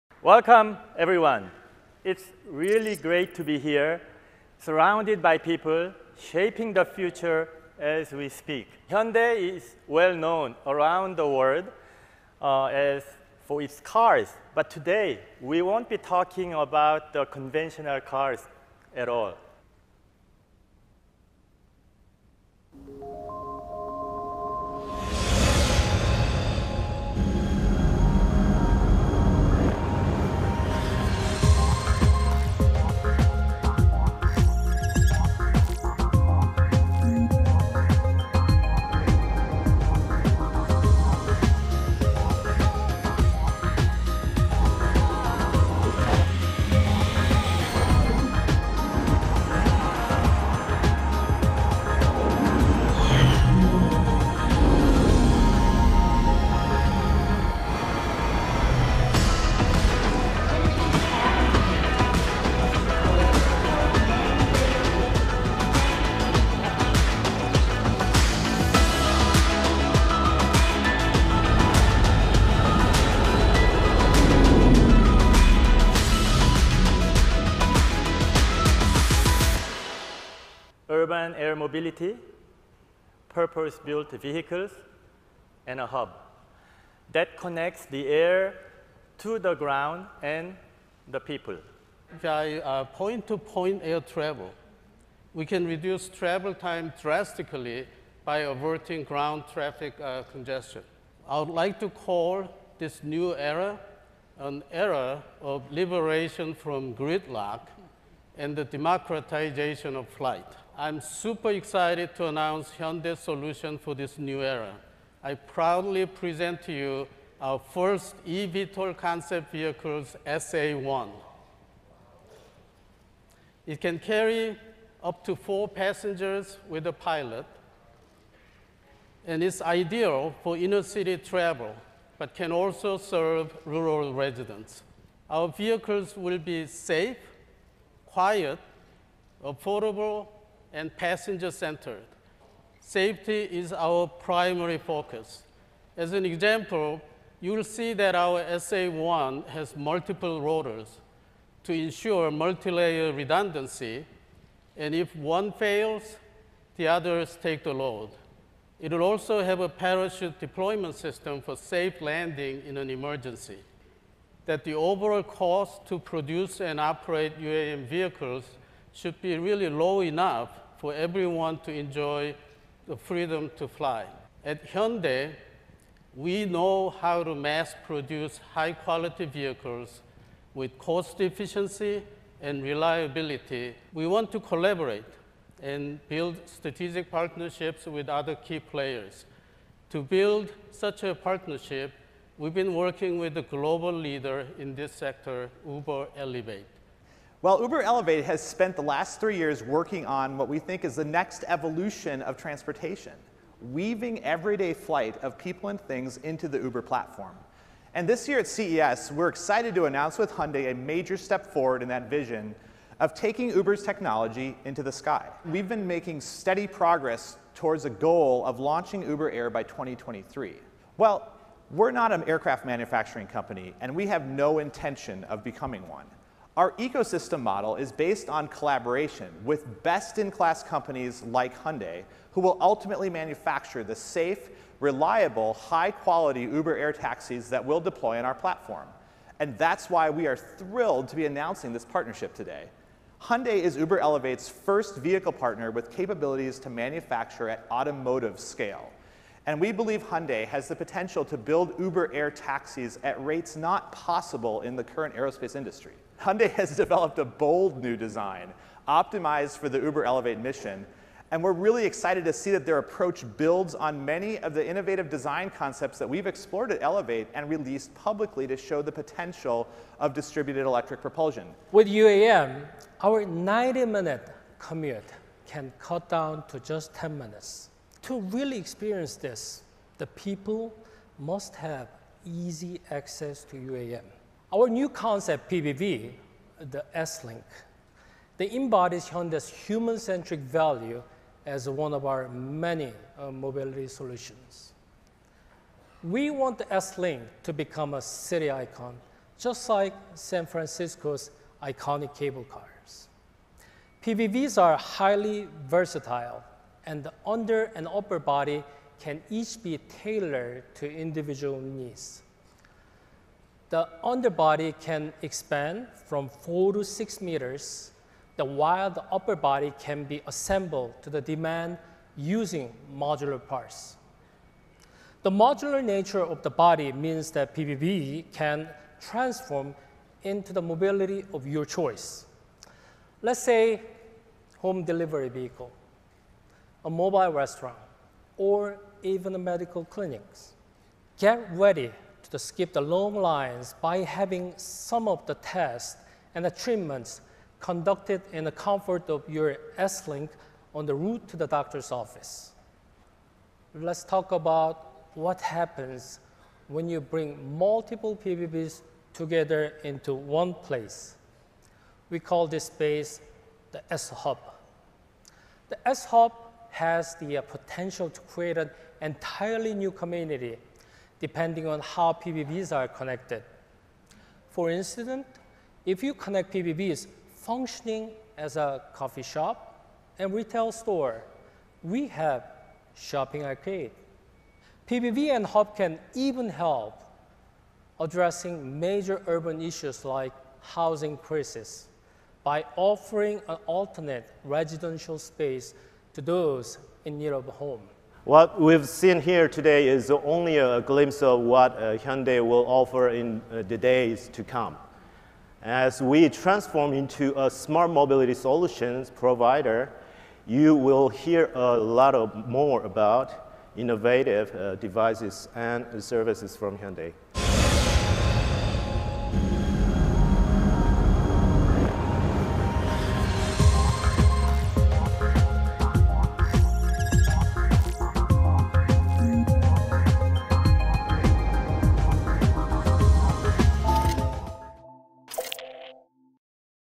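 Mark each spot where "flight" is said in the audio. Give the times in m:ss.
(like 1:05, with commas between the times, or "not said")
1:50, 3:24.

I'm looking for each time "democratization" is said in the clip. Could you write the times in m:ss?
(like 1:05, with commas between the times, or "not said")
1:48.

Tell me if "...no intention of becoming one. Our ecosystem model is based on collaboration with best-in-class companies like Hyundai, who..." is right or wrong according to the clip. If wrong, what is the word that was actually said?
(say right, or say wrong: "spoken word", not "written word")
right.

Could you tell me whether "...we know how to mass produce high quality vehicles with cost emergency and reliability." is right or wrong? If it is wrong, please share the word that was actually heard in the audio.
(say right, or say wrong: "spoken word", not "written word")
wrong: "efficiency", not "emergency".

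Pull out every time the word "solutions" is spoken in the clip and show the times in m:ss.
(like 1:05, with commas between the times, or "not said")
1:53, 4:53, 6:48.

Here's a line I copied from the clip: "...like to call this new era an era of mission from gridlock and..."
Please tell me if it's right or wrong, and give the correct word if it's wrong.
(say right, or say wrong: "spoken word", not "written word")
wrong: "liberation", not "mission".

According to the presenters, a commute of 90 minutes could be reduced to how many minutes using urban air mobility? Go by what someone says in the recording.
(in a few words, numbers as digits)
10 minutes.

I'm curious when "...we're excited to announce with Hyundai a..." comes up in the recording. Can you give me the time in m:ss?
3:29.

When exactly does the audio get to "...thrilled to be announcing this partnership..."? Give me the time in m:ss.
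4:00.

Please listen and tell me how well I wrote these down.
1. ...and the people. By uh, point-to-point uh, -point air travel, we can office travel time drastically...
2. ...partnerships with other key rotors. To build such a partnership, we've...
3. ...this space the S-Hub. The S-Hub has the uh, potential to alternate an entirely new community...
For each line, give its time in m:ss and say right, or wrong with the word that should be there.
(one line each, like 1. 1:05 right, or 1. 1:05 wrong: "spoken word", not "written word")
1. 1:30 wrong: "reduce", not "office"
2. 3:07 wrong: "players", not "rotors"
3. 6:02 wrong: "create", not "alternate".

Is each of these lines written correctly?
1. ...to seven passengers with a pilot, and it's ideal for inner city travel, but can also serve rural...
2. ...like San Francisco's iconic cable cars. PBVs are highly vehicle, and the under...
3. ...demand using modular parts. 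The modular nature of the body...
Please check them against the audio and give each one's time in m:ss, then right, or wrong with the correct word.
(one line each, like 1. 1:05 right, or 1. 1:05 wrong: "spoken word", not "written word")
1. 2:05 wrong: "four", not "seven"
2. 4:59 wrong: "versatile", not "vehicle"
3. 5:21 right.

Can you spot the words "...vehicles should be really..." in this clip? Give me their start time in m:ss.
2:47.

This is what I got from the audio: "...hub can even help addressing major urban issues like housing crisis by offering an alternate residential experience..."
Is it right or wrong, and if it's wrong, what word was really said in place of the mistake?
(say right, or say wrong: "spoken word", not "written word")
wrong: "space", not "experience".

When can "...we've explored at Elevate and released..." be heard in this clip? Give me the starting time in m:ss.
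4:26.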